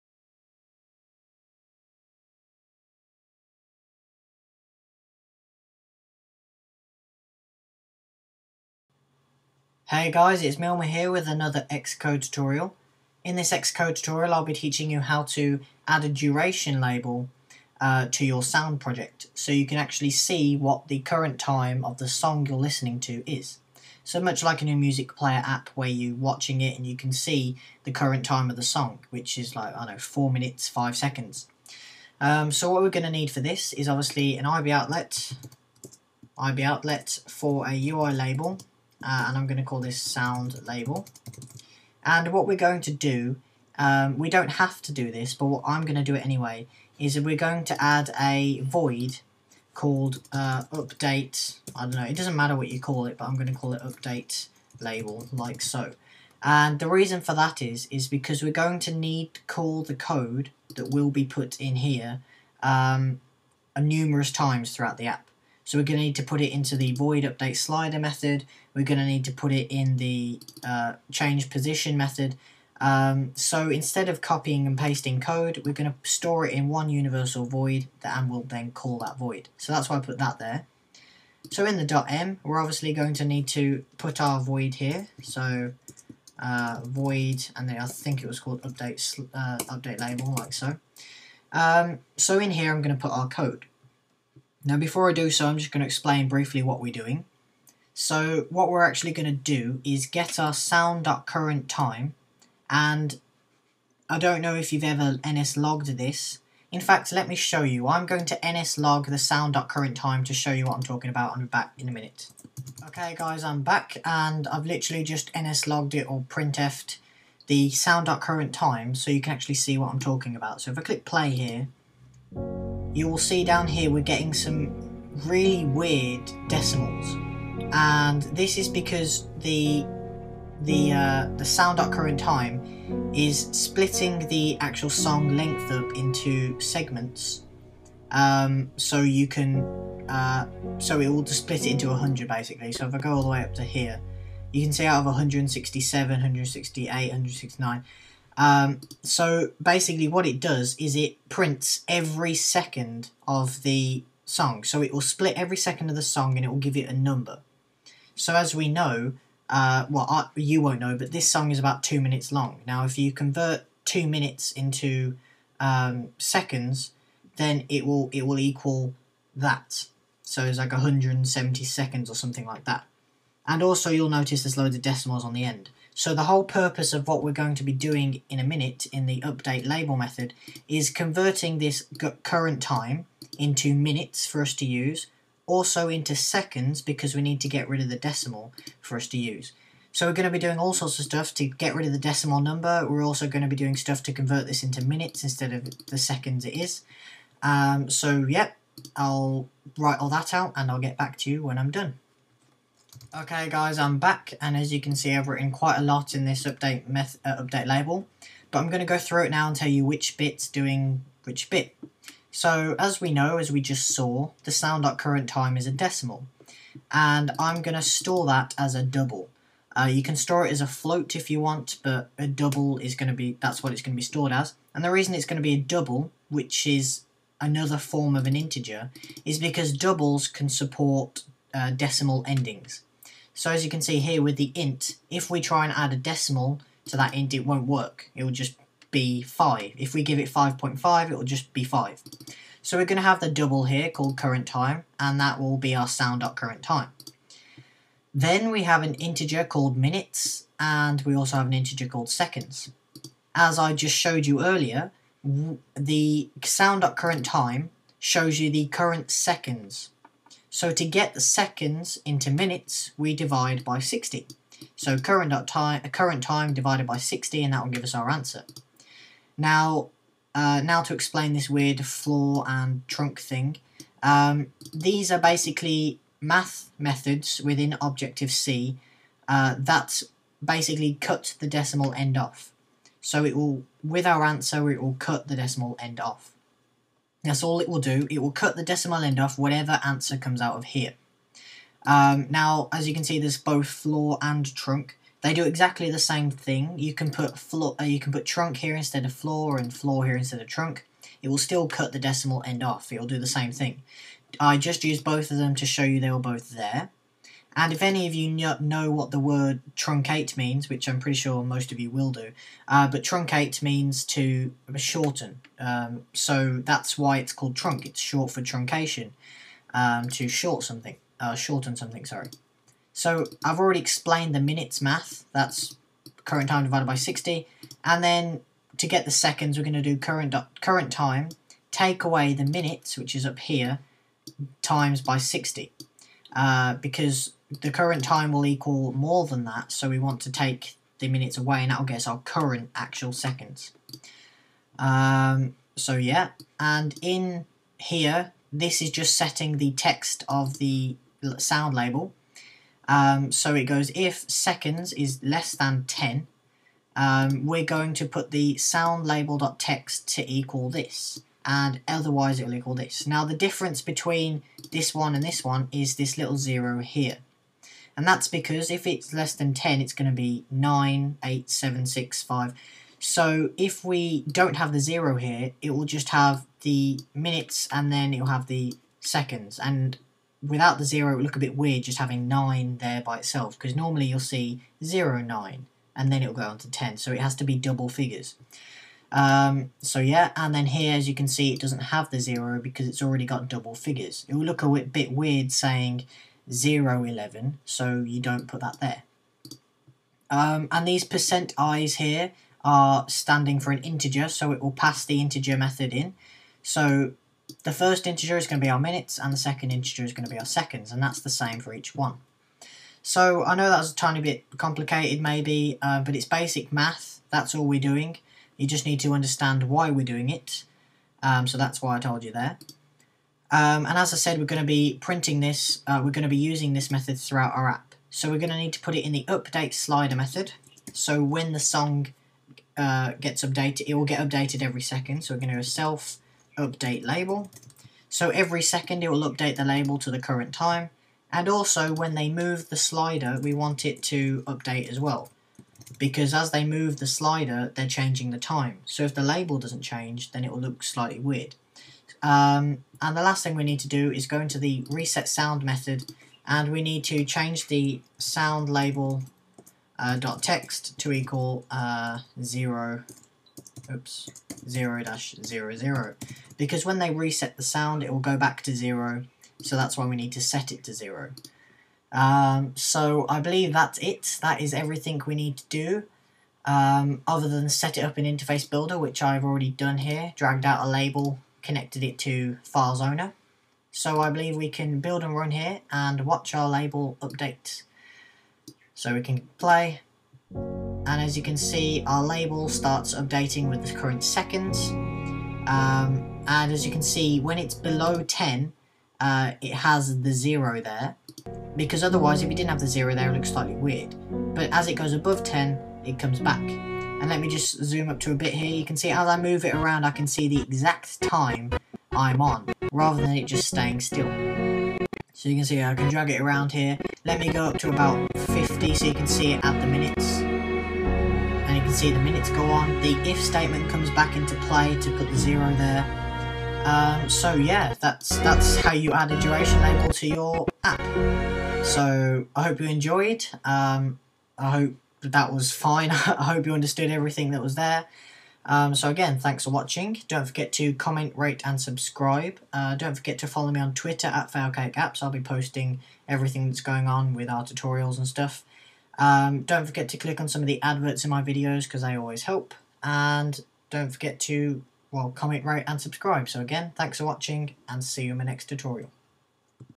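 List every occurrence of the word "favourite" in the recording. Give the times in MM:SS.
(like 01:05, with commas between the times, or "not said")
not said.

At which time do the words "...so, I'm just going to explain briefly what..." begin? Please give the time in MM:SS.
01:35.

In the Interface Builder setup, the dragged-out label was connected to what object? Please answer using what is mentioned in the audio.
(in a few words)
Files Owner.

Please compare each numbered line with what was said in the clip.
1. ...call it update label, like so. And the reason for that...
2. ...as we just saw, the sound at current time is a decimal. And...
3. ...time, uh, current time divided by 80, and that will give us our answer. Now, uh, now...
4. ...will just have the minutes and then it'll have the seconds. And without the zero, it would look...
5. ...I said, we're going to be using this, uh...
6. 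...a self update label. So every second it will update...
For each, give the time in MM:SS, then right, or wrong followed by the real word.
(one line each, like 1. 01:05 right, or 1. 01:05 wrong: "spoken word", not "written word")
1. 00:53 right
2. 03:33 right
3. 04:25 wrong: "60", not "80"
4. 06:15 right
5. 07:04 wrong: "printing", not "using"
6. 07:15 right.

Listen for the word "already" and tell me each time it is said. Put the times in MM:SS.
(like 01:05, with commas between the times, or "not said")
05:23, 06:33, 07:59.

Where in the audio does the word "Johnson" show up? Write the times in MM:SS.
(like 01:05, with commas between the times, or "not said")
not said.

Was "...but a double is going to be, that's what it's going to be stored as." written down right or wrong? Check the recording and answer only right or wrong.
right.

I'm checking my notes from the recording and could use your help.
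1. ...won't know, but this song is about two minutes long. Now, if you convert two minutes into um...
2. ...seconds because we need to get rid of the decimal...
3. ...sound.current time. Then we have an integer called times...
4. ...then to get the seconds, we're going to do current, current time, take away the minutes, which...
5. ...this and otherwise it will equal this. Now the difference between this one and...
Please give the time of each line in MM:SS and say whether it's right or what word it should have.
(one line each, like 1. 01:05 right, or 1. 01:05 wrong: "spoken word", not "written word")
1. 02:40 right
2. 03:06 right
3. 04:05 wrong: "minutes", not "times"
4. 05:28 right
5. 06:00 right.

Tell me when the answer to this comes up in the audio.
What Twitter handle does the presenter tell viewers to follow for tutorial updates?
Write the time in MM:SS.
09:04.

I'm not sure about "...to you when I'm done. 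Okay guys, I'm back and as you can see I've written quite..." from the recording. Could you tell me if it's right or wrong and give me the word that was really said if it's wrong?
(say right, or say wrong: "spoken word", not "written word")
right.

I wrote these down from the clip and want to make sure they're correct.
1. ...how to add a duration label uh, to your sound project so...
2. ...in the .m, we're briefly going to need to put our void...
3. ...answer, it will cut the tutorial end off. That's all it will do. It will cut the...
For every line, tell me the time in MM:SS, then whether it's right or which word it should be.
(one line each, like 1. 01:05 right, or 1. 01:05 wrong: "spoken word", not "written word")
1. 00:15 right
2. 01:21 wrong: "obviously", not "briefly"
3. 04:44 wrong: "decimal", not "tutorial".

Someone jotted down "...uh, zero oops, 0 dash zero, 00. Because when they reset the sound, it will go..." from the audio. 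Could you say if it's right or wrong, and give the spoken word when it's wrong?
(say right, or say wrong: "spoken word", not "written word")
right.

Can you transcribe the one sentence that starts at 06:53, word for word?
So I know that was a tiny bit complicated maybe, uh, but it's basic math, that's all we're doing.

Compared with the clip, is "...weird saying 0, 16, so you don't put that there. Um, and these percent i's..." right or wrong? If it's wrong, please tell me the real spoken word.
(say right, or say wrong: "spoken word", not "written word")
wrong: "11", not "16".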